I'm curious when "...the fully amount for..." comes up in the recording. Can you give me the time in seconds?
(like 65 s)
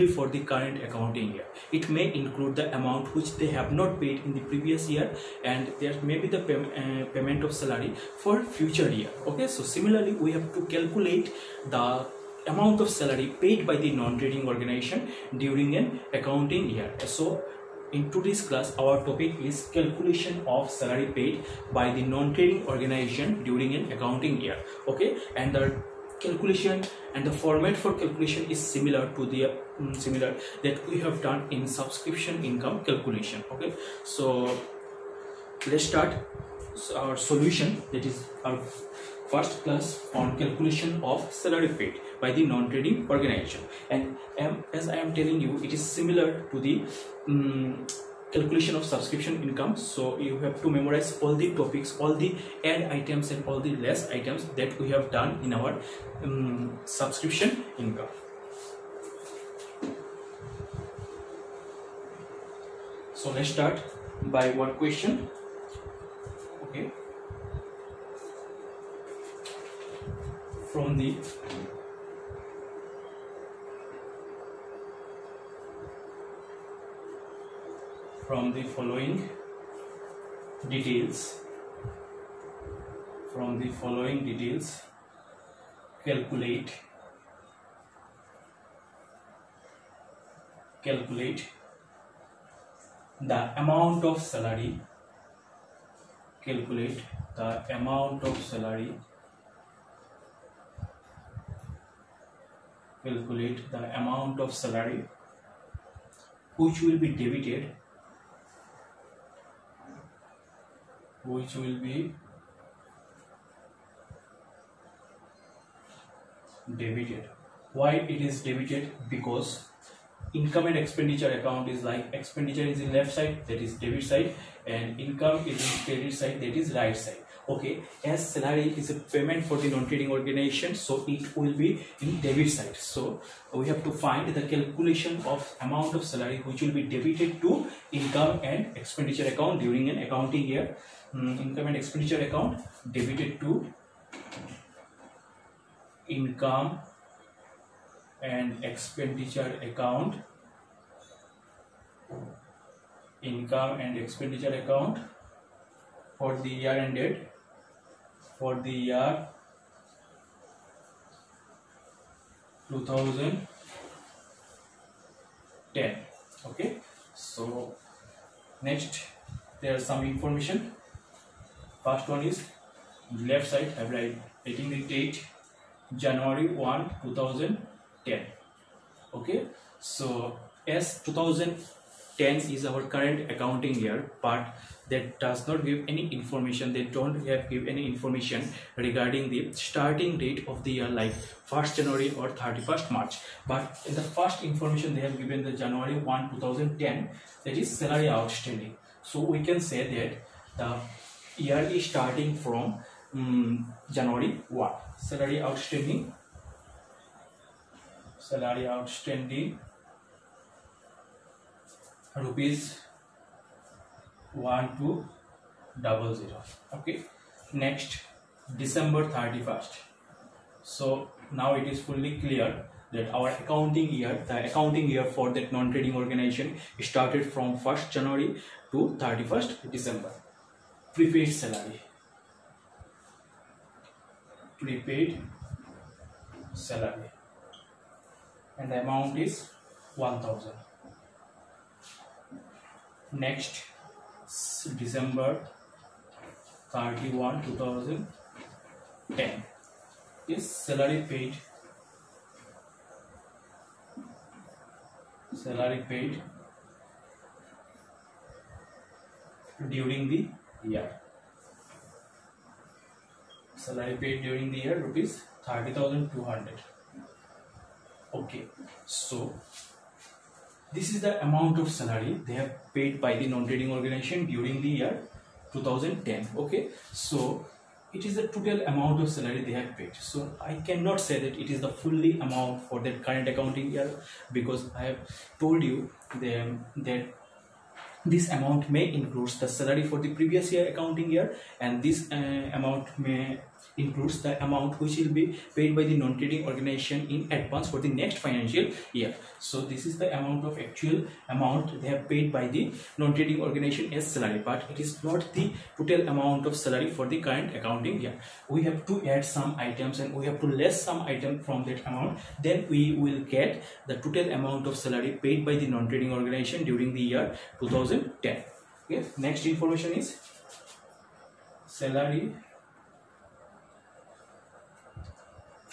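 281 s.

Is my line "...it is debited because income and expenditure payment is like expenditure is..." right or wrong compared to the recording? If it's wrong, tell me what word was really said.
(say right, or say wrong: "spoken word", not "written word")
wrong: "account", not "payment".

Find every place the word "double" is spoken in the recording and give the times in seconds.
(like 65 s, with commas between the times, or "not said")
215 s.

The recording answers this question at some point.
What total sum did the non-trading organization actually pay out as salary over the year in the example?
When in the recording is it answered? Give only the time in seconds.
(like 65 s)
265 s.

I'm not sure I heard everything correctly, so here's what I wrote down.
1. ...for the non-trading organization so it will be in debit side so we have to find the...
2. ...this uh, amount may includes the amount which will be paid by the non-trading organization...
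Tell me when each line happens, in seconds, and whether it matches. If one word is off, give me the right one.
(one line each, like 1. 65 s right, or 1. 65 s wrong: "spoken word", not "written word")
1. 129 s right
2. 291 s right.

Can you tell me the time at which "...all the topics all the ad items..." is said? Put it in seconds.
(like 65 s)
51 s.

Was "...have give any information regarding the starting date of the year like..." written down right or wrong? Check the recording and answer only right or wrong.
right.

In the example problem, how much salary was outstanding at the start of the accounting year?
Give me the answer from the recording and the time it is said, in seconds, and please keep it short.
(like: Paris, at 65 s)
Rs 1,200, at 214 s.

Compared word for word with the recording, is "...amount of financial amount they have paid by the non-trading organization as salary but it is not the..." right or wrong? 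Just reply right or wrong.
wrong.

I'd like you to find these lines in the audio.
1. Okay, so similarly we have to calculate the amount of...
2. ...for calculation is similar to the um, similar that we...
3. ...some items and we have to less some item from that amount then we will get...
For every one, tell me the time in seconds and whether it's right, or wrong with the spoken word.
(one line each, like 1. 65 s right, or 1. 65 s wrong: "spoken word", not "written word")
1. 9 s right
2. 27 s right
3. 309 s right.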